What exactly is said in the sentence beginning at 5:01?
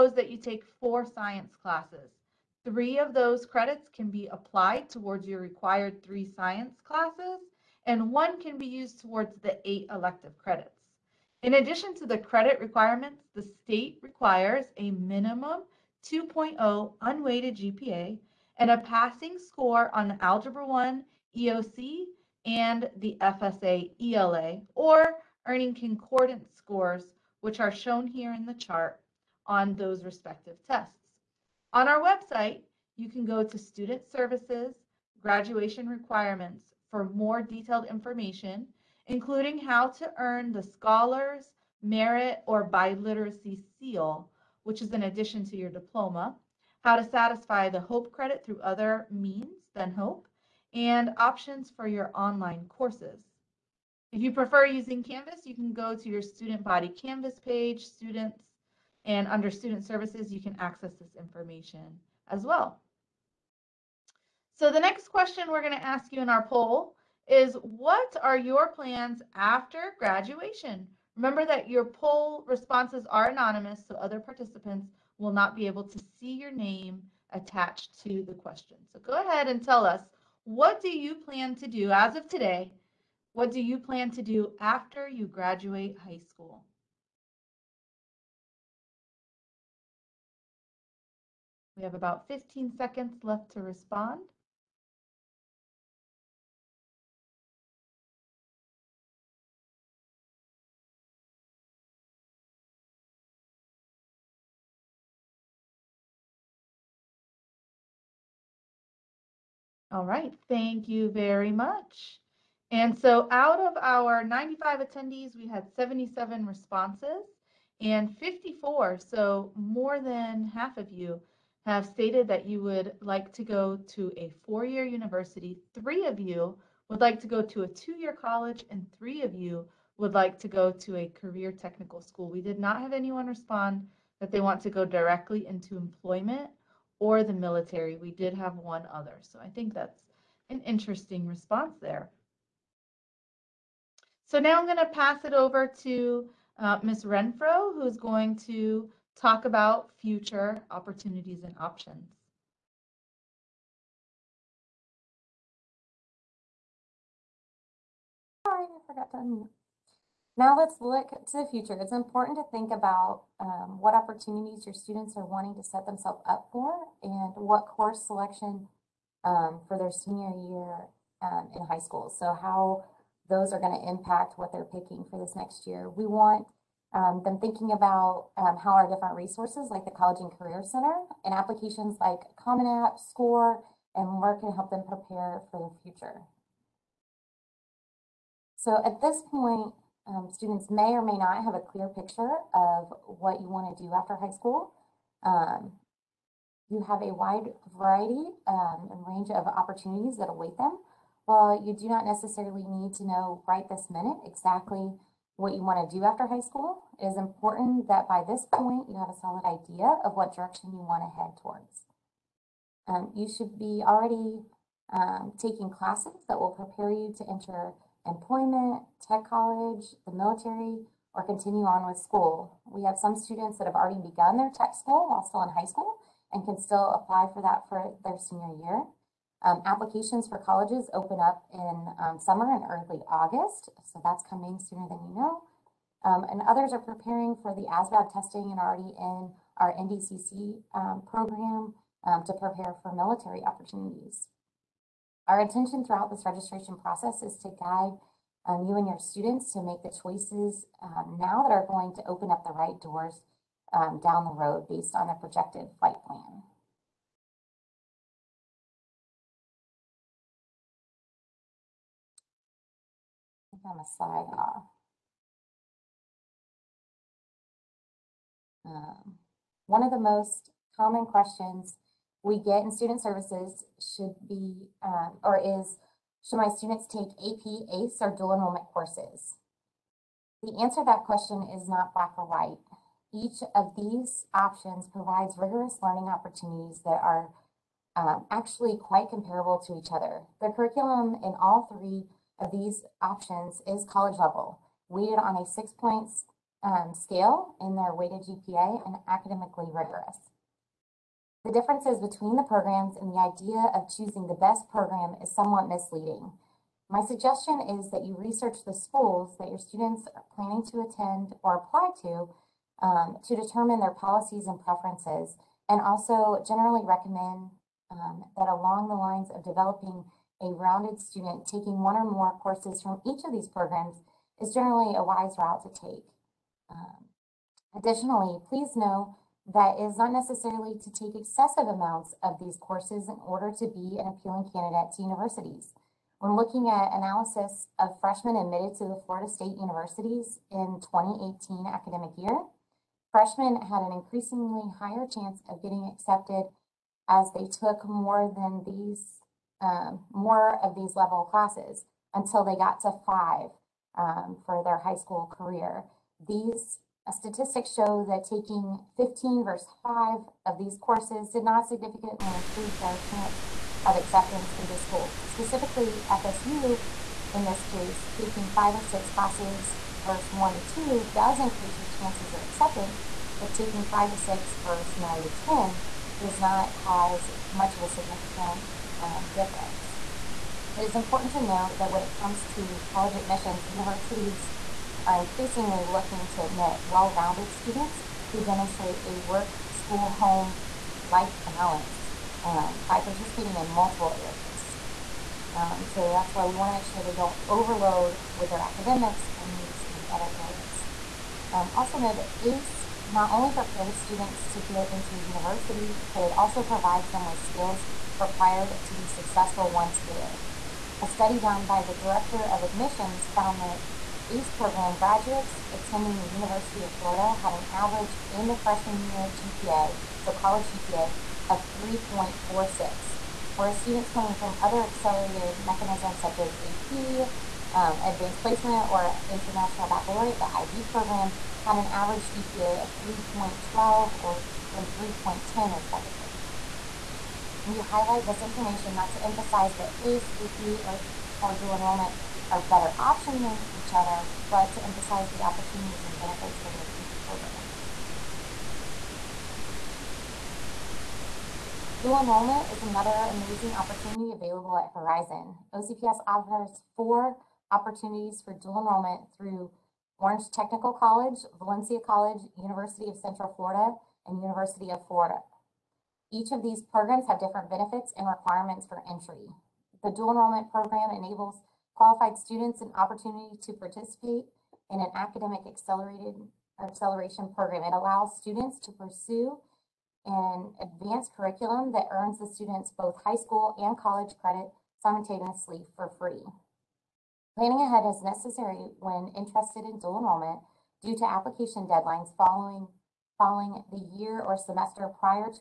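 The differences between the programs and the idea of choosing the best program is somewhat misleading.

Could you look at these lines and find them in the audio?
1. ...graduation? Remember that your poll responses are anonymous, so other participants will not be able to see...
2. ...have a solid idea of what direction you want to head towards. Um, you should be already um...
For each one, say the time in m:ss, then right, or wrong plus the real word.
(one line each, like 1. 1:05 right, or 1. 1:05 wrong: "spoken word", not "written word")
1. 1:09 right
2. 3:28 right.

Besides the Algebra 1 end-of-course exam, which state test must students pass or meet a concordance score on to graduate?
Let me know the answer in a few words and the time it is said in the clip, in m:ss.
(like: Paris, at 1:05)
FSA ELA, at 0:23.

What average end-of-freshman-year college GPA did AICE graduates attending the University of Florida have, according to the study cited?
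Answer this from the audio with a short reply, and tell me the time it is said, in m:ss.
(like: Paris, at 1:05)
3.46, at 7:01.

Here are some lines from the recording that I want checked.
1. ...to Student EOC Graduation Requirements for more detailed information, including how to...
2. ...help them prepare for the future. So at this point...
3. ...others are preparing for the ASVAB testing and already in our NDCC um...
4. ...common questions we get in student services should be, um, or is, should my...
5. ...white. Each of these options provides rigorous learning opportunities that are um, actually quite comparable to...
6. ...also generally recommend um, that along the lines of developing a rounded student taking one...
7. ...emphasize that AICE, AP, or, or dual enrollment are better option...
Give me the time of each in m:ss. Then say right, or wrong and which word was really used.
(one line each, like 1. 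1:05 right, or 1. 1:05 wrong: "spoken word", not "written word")
1. 0:33 wrong: "Services", not "EOC"
2. 3:04 right
3. 3:56 right
4. 4:30 right
5. 4:42 right
6. 5:15 right
7. 7:19 right.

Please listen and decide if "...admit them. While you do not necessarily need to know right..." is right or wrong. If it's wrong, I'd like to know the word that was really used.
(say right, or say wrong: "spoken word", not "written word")
wrong: "await", not "admit".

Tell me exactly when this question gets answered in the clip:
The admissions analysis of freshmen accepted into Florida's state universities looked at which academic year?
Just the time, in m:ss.
5:40.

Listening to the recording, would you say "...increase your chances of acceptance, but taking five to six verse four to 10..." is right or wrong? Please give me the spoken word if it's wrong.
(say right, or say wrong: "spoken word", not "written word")
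wrong: "nine", not "four".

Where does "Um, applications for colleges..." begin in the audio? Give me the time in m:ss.
3:49.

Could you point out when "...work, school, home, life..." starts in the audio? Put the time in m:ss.
6:29.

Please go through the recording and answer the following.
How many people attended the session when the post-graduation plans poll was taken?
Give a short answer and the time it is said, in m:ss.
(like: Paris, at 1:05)
95, at 1:54.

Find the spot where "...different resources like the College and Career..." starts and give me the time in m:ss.
2:58.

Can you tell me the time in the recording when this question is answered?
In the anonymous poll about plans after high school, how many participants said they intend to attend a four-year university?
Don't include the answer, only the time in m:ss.
1:58.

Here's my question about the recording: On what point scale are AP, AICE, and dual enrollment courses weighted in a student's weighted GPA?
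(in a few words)
6.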